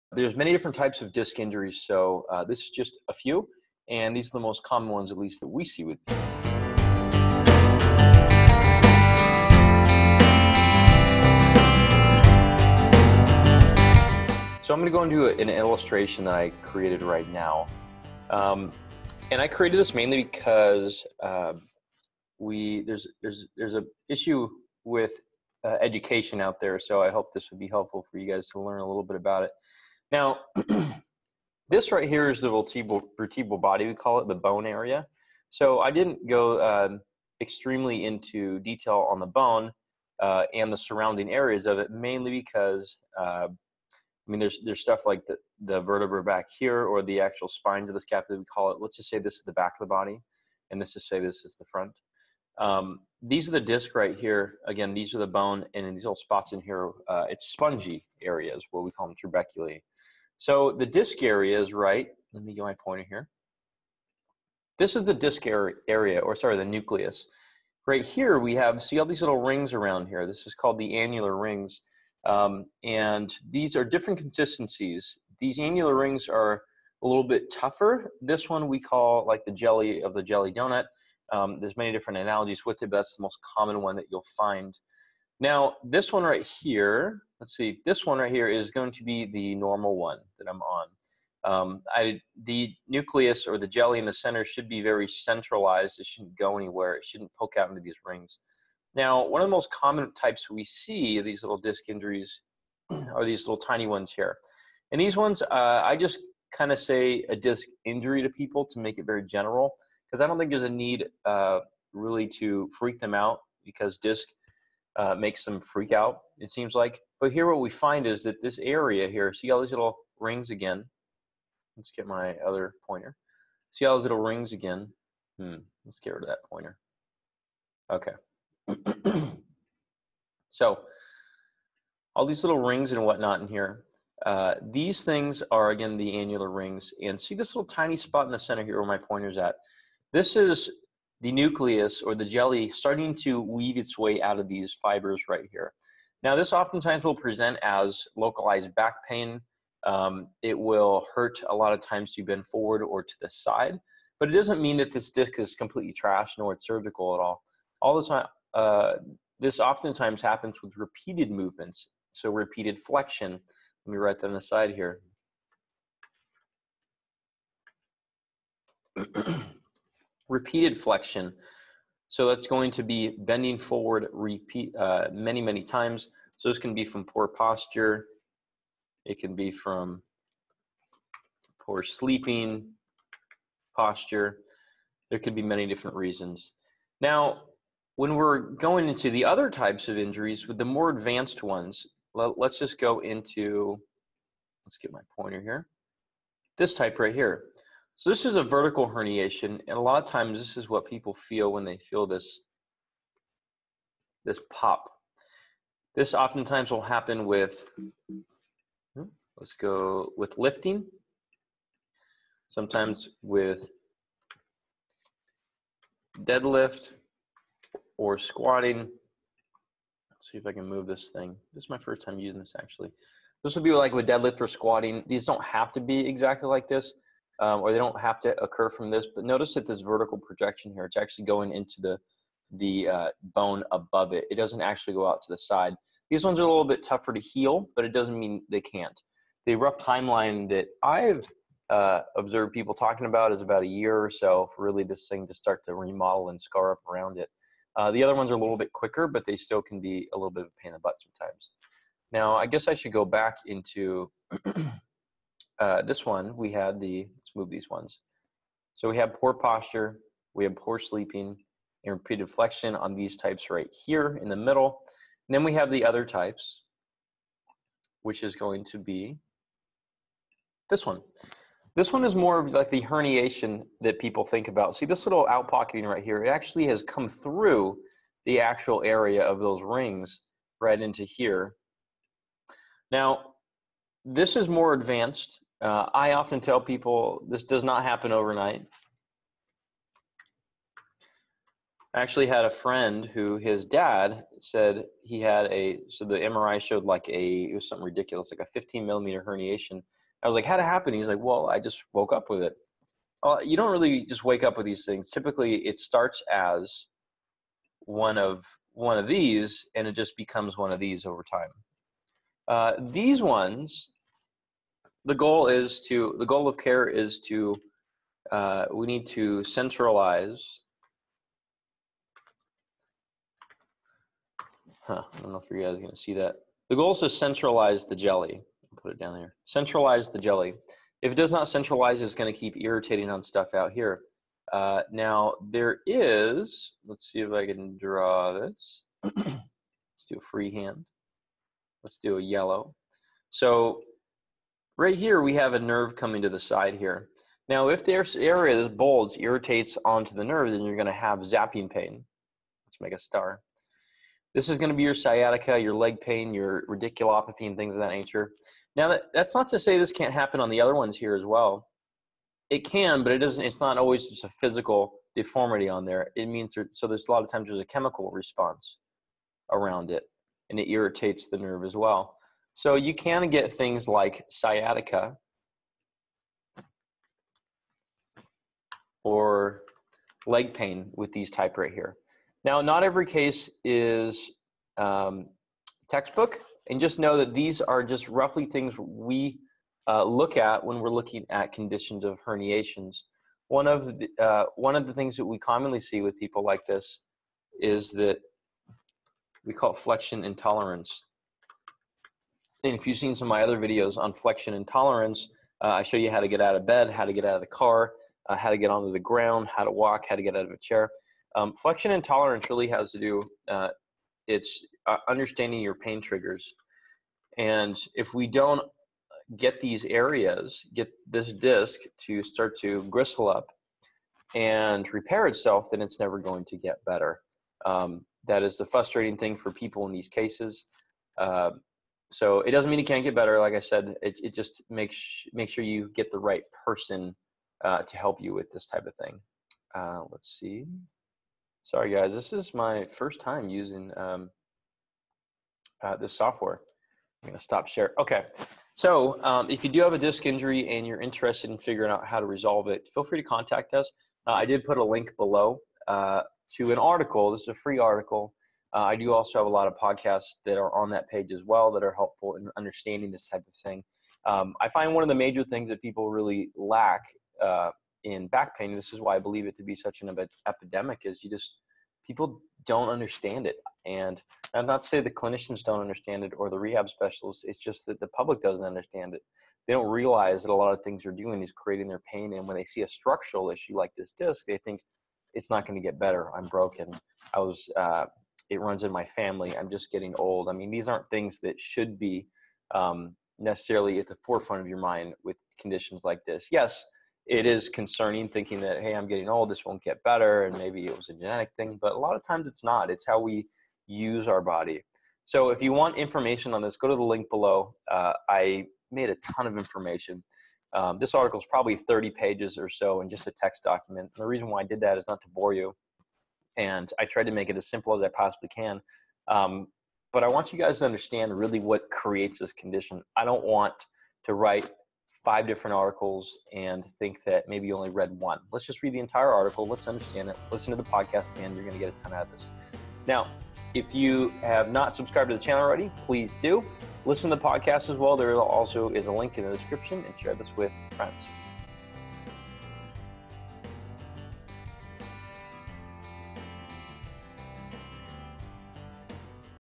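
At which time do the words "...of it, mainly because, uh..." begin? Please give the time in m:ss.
0:41.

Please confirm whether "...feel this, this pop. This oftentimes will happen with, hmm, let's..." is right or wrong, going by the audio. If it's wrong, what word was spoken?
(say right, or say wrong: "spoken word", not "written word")
right.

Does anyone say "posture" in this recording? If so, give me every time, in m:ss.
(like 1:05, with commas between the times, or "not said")
2:57, 3:03, 4:19.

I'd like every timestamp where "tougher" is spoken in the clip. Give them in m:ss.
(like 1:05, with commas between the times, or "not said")
1:17, 3:56.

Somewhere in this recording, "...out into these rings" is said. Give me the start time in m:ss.
1:37.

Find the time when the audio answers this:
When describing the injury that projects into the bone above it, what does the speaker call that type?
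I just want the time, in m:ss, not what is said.
3:18.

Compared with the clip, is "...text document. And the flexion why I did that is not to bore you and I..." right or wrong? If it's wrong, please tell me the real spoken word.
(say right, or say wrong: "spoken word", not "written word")
wrong: "reason", not "flexion".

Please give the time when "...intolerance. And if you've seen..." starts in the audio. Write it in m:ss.
6:40.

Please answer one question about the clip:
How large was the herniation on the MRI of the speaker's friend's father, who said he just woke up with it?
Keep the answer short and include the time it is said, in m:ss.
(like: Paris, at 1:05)
15 millimeter, at 4:58.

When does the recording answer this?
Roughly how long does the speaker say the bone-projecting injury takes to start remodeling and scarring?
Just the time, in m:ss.
4:03.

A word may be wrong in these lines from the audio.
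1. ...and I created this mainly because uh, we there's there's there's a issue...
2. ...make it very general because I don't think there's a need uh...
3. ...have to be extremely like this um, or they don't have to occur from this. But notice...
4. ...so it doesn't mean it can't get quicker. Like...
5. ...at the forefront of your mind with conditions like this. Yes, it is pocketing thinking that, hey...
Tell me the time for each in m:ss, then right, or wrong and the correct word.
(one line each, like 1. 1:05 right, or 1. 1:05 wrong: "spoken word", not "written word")
1. 0:19 right
2. 1:48 right
3. 3:45 wrong: "exactly", not "extremely"
4. 7:12 wrong: "better", not "quicker"
5. 8:13 wrong: "concerning", not "pocketing".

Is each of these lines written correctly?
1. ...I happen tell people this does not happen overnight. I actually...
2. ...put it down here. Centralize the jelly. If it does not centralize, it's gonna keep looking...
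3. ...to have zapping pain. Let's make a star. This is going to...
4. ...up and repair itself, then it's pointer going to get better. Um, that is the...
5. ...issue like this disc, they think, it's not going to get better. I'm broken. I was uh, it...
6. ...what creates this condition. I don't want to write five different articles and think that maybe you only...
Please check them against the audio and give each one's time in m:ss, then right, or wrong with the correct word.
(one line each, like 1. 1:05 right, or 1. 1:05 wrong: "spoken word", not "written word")
1. 4:45 wrong: "often", not "happen"
2. 5:28 wrong: "irritating", not "looking"
3. 5:50 right
4. 7:03 wrong: "never", not "pointer"
5. 8:03 right
6. 8:41 right.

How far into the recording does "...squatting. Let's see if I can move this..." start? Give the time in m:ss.
3:38.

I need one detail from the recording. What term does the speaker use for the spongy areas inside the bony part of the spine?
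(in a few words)
trabeculae.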